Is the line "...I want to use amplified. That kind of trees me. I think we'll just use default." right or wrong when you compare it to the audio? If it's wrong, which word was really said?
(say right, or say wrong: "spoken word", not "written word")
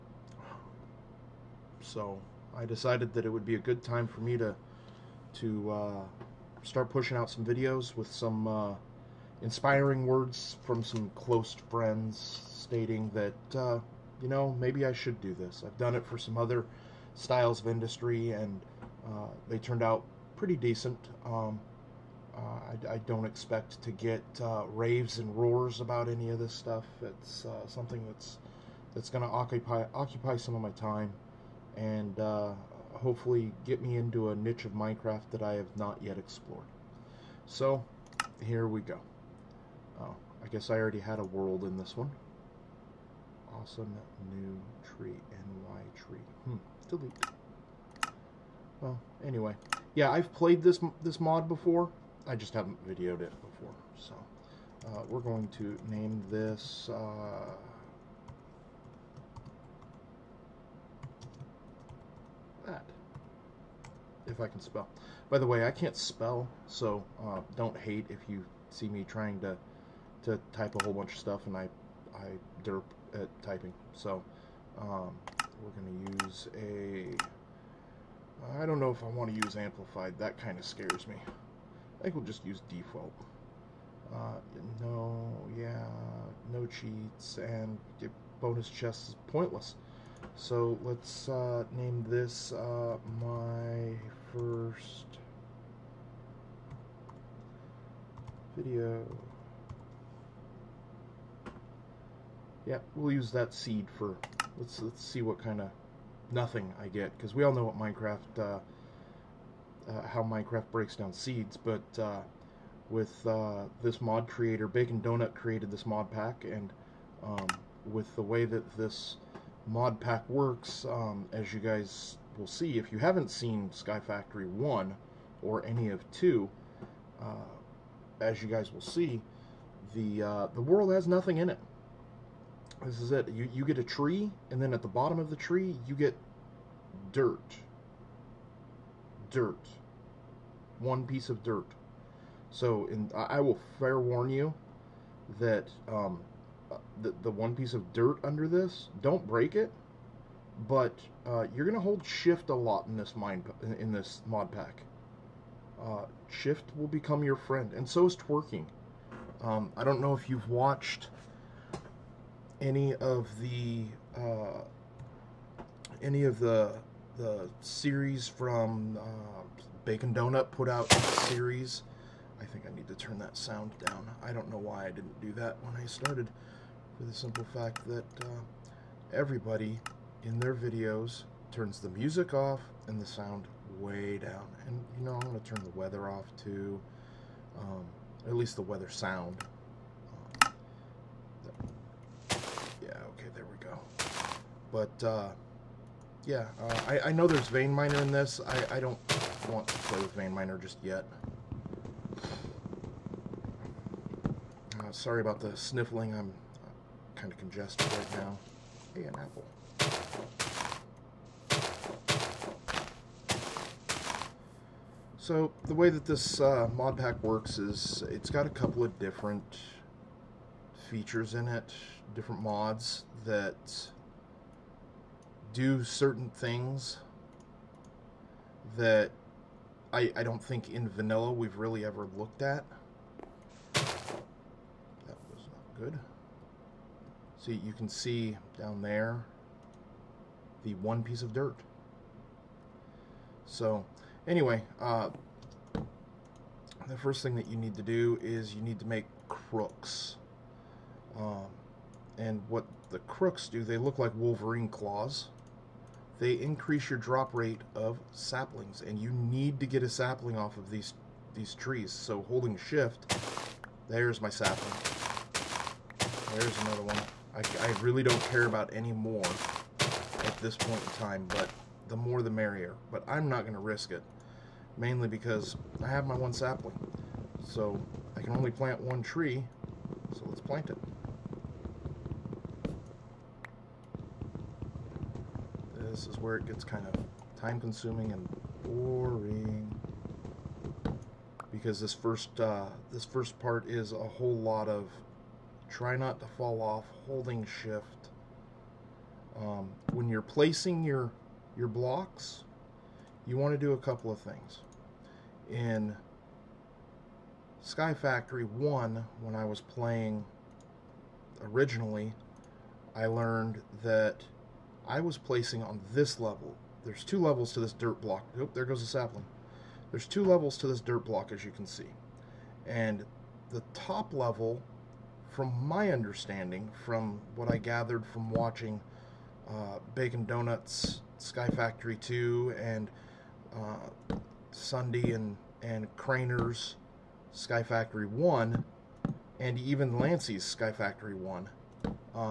wrong: "scares", not "trees".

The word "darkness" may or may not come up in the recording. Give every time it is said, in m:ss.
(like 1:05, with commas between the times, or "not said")
not said.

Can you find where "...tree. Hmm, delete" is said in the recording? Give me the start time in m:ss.
0:45.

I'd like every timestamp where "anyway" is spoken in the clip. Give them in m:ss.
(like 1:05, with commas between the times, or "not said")
0:49, 4:04.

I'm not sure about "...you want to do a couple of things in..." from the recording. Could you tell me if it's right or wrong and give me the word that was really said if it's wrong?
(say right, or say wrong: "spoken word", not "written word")
right.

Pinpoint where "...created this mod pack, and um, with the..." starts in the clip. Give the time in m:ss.
1:55.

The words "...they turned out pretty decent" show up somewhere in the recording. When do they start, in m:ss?
0:19.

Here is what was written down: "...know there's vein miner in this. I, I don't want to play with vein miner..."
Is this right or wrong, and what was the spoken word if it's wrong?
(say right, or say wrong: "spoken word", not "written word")
right.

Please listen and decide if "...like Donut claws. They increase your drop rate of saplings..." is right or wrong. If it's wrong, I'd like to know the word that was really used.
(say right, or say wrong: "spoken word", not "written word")
wrong: "Wolverine", not "Donut".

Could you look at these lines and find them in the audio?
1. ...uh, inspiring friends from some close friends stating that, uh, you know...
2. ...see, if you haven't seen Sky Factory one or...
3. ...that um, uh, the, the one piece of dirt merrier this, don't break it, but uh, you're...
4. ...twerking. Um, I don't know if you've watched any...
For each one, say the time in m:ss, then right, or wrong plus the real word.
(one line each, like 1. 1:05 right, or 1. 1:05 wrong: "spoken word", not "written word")
1. 0:08 wrong: "words", not "friends"
2. 2:02 right
3. 2:25 wrong: "under", not "merrier"
4. 2:38 right.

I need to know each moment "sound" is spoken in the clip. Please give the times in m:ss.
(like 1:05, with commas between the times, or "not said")
2:53, 3:03, 3:08.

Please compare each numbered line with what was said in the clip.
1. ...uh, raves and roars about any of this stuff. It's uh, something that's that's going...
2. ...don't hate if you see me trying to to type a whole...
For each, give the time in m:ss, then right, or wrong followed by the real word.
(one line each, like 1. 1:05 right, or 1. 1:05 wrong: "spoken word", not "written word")
1. 0:24 right
2. 1:07 right.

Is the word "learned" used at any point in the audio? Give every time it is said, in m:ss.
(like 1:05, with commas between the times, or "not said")
5:13.